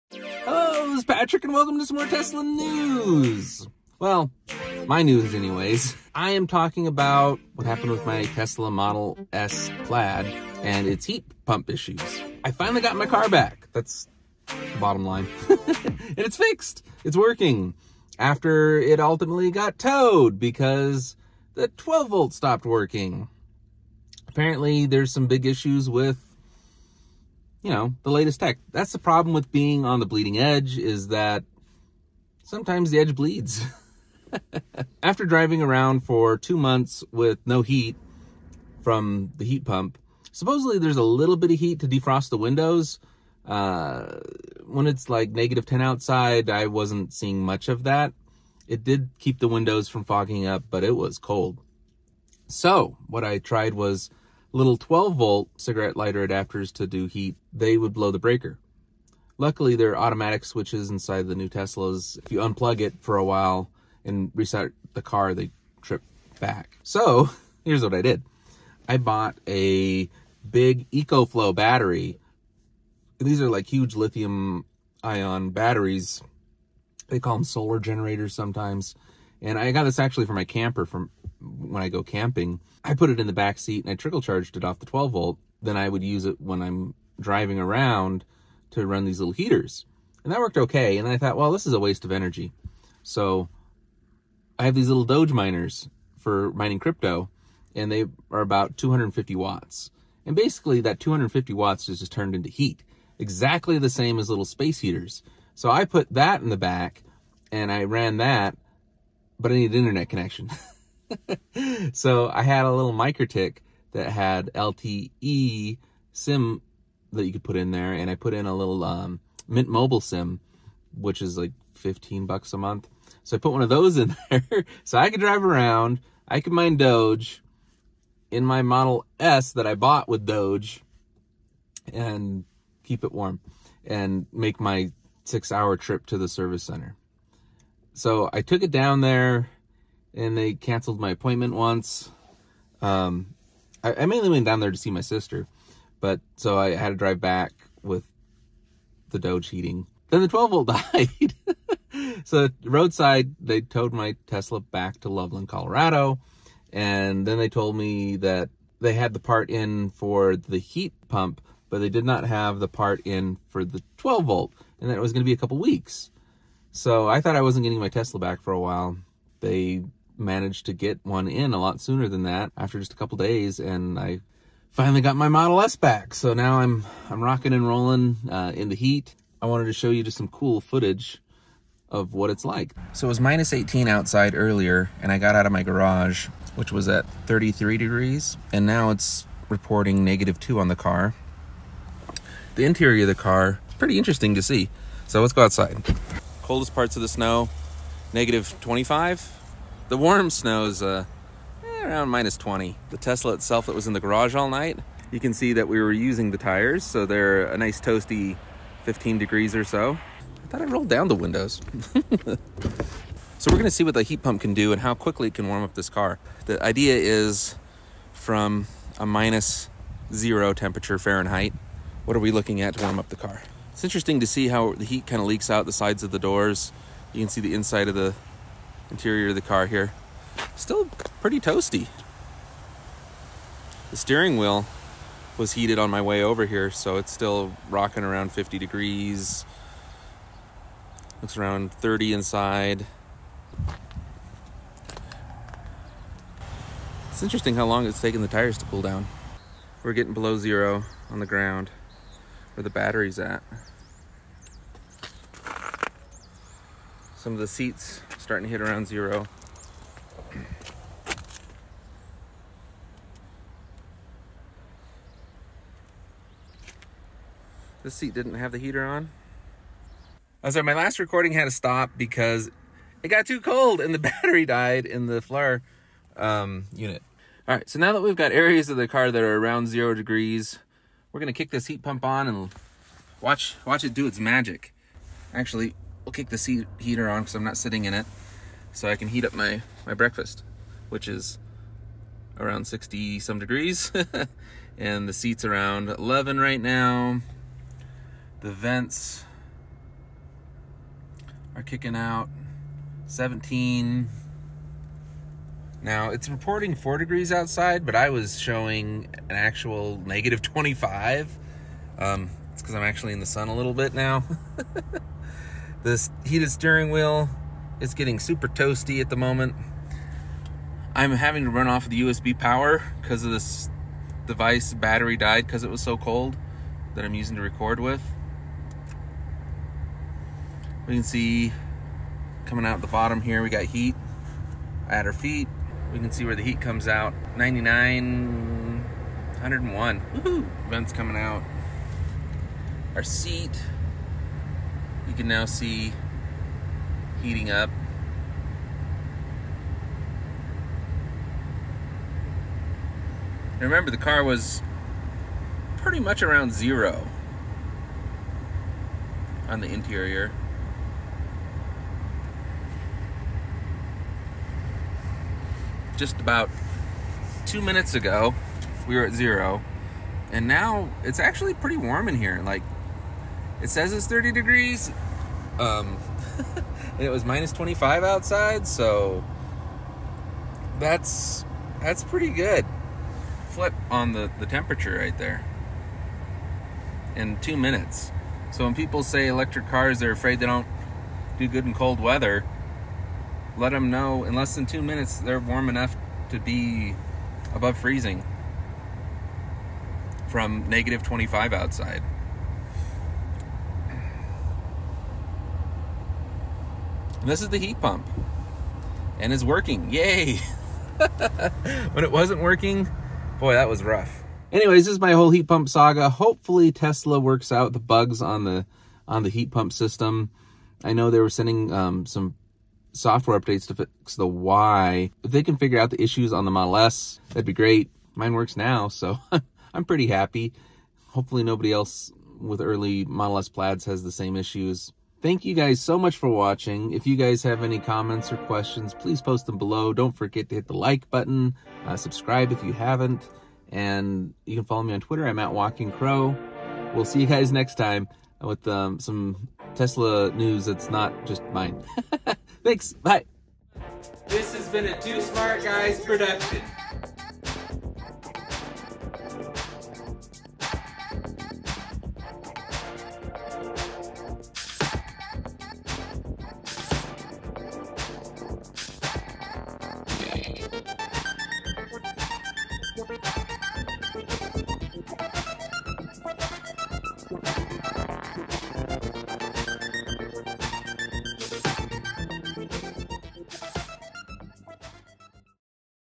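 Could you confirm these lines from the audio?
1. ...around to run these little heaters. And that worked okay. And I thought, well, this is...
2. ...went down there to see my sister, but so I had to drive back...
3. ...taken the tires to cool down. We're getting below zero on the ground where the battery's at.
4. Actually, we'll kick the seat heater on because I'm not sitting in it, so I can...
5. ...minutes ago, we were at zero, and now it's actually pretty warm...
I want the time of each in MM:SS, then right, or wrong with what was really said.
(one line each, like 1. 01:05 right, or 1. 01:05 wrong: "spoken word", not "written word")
1. 01:27 right
2. 02:24 right
3. 04:08 right
4. 04:45 right
5. 06:07 right.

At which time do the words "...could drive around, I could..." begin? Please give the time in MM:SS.
02:05.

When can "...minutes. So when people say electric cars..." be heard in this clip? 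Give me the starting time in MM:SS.
06:27.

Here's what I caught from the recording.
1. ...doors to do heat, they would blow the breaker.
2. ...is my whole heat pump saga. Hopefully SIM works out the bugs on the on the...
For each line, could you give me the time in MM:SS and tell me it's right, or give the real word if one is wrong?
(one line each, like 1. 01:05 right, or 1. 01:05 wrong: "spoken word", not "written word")
1. 00:56 wrong: "adapters", not "doors"
2. 06:54 wrong: "Tesla", not "SIM".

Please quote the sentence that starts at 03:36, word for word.
The idea is from a minus zero temperature Fahrenheit, what are we looking at to warm up the car?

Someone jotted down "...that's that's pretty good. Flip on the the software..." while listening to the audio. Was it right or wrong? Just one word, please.
wrong.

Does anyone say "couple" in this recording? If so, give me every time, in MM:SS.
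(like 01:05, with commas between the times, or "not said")
02:45, 02:52.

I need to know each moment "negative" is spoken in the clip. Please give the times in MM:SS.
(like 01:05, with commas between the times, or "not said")
00:45, 03:10, 03:18, 05:10, 06:40.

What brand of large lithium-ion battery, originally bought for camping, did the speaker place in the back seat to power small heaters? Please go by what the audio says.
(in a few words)
EcoFlow.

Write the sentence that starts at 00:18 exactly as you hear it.
After it ultimately got towed because the 12 volt stopped working.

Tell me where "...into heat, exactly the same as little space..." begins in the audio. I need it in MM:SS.
01:42.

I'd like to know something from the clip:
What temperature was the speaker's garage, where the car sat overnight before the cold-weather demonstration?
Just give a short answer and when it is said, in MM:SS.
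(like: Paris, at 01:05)
33 degrees, at 03:07.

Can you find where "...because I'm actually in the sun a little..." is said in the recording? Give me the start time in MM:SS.
05:12.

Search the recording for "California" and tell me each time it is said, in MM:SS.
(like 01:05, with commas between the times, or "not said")
not said.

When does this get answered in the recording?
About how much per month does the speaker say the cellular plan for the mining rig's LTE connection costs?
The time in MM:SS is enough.
02:01.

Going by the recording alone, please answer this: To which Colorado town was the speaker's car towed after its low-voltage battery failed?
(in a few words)
Loveland.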